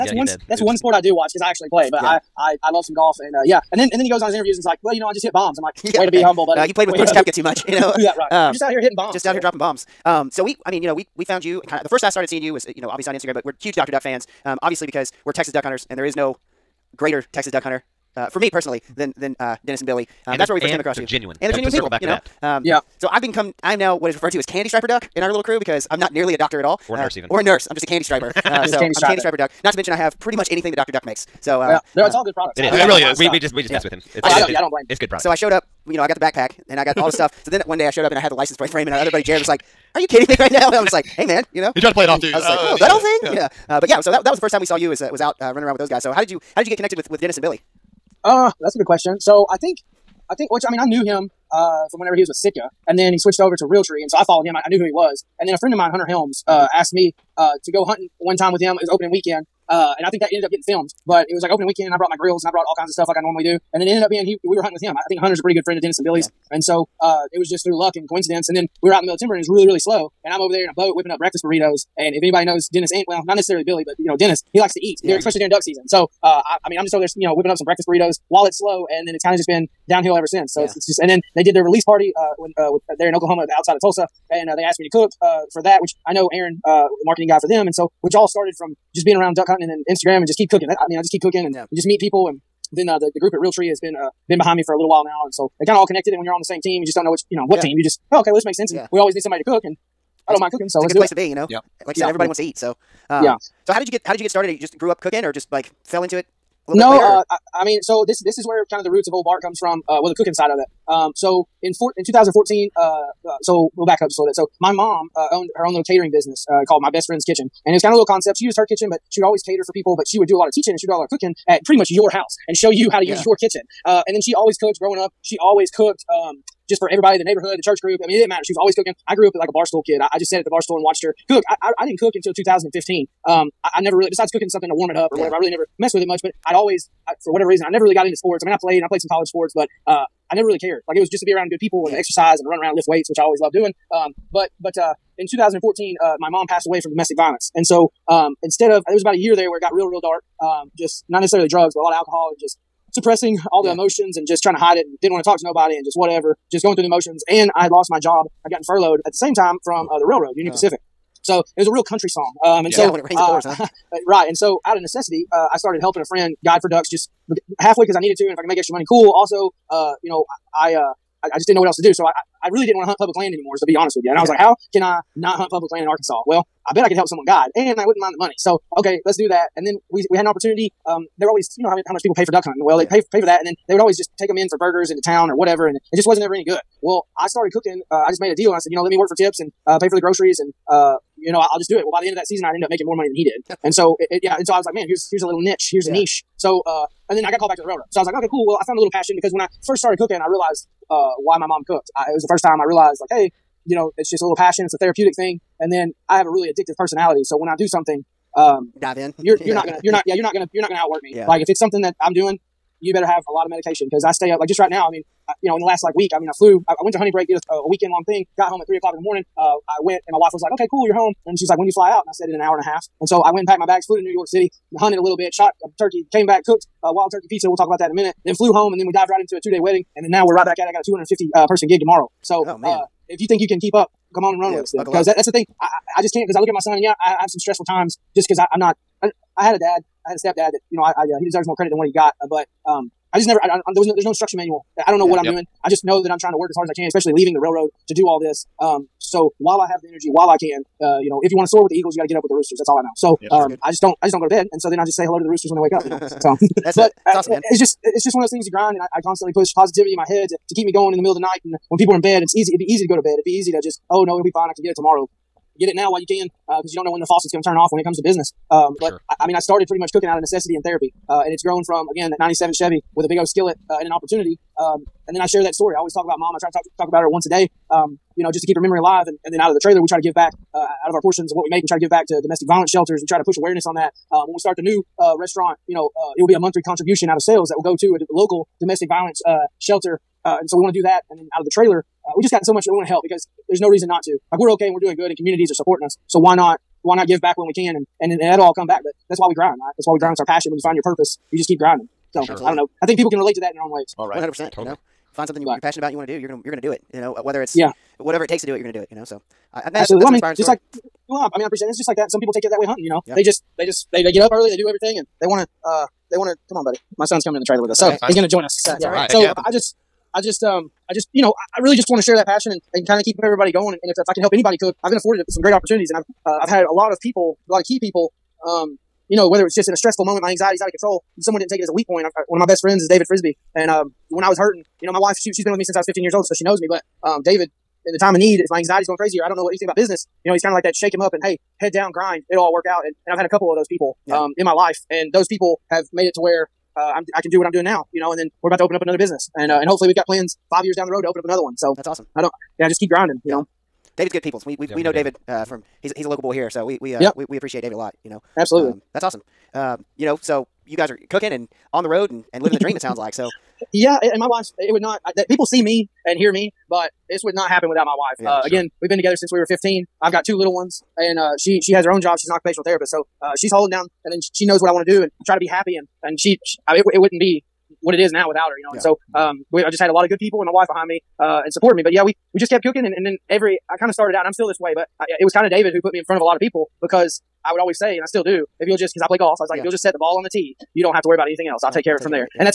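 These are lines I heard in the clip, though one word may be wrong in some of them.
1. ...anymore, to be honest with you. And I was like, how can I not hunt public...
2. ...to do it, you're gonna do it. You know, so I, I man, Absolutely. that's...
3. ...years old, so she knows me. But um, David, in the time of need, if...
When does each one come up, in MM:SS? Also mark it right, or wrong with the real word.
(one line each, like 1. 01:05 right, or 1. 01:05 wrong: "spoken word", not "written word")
1. 02:53 right
2. 05:08 right
3. 05:36 right.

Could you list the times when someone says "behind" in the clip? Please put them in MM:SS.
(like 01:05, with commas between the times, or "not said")
01:34, 06:20.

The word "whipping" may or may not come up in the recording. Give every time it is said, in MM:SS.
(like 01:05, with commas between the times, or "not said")
01:10, 01:17.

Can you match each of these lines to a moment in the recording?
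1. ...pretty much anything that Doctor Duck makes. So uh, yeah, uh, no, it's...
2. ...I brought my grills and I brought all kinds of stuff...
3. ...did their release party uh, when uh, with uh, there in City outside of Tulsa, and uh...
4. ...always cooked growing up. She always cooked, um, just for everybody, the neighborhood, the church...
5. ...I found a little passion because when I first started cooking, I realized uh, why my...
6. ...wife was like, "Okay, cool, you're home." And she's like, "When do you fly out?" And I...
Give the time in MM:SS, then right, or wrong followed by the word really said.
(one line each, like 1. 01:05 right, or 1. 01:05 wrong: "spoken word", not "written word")
1. 00:30 right
2. 01:01 right
3. 01:21 wrong: "Oklahoma", not "City"
4. 02:04 right
5. 03:18 right
6. 03:40 right.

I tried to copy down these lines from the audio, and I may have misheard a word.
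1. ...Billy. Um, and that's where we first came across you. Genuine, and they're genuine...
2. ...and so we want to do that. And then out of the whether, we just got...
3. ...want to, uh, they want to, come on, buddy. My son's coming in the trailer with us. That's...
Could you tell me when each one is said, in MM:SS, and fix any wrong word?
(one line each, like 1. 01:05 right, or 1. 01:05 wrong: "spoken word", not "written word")
1. 00:19 right
2. 04:50 wrong: "trailer", not "whether"
3. 05:15 right.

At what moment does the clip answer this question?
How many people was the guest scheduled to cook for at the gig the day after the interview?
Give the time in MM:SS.
03:50.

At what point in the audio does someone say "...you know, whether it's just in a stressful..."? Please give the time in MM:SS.
05:29.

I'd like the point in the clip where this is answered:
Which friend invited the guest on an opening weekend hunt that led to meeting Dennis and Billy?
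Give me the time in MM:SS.
00:55.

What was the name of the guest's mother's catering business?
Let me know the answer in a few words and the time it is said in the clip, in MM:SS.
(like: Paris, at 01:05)
My Best Friend's Kitchen, at 01:56.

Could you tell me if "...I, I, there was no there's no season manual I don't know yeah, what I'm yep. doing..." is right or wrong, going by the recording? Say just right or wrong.
wrong.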